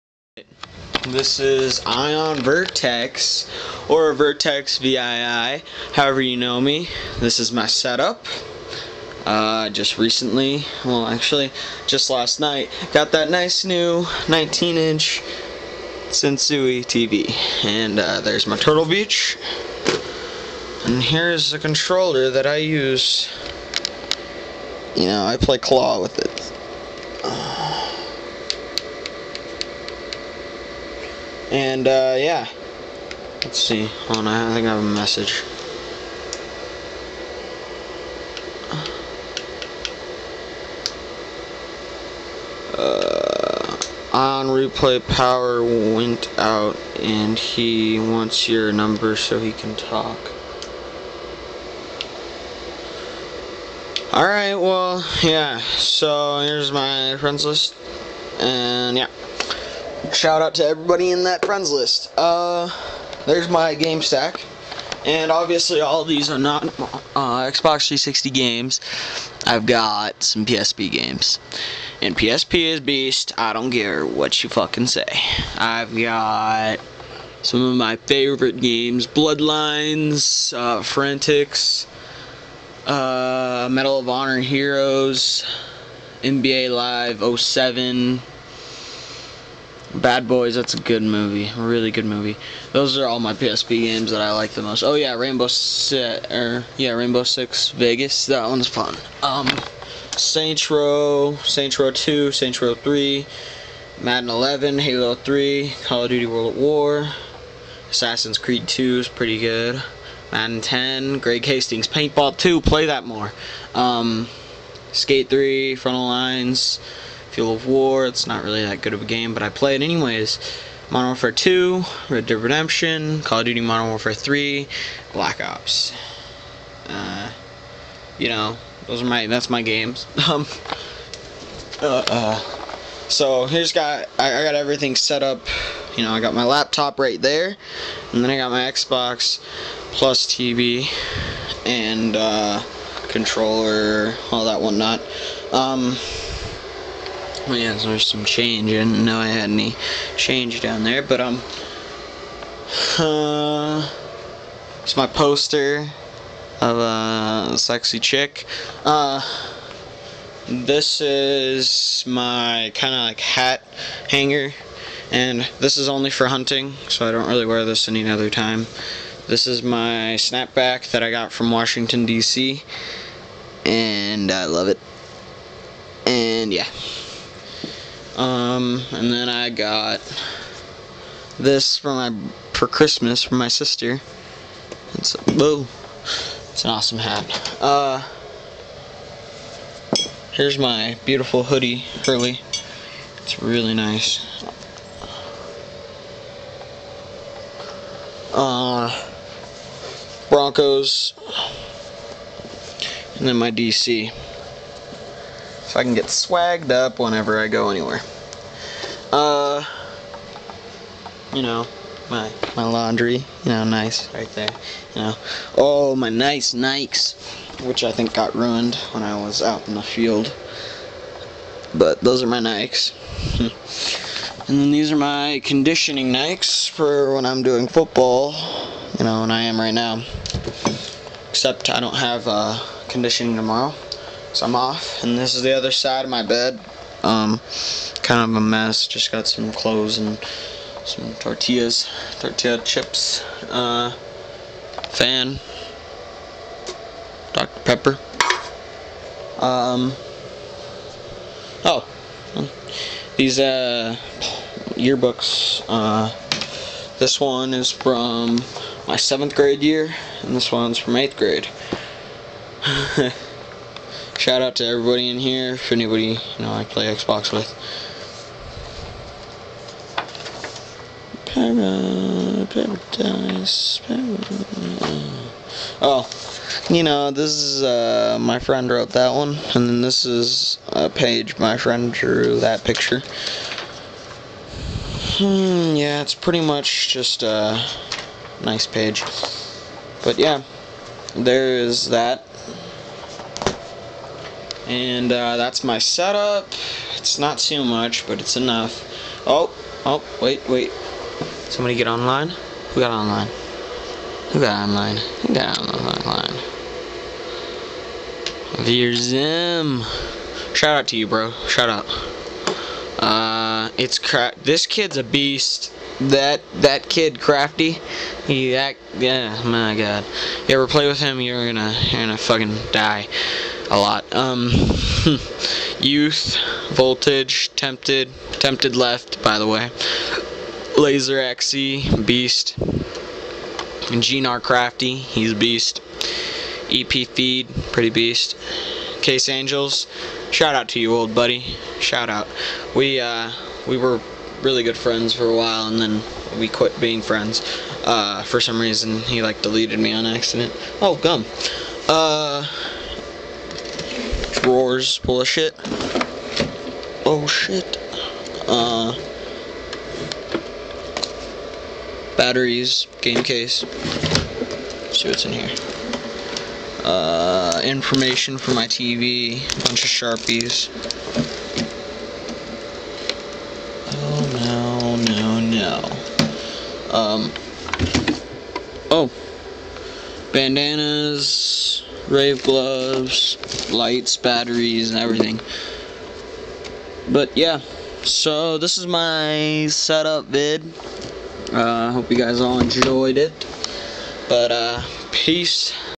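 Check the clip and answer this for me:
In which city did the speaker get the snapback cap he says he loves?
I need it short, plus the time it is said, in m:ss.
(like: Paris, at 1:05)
Washington D.C., at 2:51.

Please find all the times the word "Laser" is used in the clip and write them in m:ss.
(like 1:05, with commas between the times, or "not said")
5:30.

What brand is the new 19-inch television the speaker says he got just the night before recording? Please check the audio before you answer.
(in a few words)
Sansui.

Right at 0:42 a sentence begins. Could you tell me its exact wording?
Uh, on replay, power went out, and he wants your number so he can talk.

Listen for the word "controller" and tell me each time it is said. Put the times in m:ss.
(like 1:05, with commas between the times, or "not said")
0:21, 2:23.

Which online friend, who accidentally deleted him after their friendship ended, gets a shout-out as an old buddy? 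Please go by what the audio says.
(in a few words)
Case Angels.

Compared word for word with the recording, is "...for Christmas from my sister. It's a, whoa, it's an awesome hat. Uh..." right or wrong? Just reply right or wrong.
right.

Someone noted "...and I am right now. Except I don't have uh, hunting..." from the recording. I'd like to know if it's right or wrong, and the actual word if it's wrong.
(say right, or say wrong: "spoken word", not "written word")
wrong: "conditioning", not "hunting".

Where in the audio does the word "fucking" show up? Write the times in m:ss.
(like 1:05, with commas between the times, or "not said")
1:14, 5:22.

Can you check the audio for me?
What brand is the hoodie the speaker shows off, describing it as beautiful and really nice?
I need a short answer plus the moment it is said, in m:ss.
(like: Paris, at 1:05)
Hurley, at 3:12.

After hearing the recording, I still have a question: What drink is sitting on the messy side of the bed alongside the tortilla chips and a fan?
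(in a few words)
Dr. Pepper.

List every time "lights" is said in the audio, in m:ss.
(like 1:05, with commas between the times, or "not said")
6:23.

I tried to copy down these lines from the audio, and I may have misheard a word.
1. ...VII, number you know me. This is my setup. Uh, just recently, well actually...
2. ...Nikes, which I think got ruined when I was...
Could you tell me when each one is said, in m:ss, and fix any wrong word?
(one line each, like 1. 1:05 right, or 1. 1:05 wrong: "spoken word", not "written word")
1. 0:04 wrong: "however", not "number"
2. 3:36 right.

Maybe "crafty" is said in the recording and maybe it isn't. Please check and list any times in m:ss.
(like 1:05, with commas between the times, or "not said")
5:17, 5:34.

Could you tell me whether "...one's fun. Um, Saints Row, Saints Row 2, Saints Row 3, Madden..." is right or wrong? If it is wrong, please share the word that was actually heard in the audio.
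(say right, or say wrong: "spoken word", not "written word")
right.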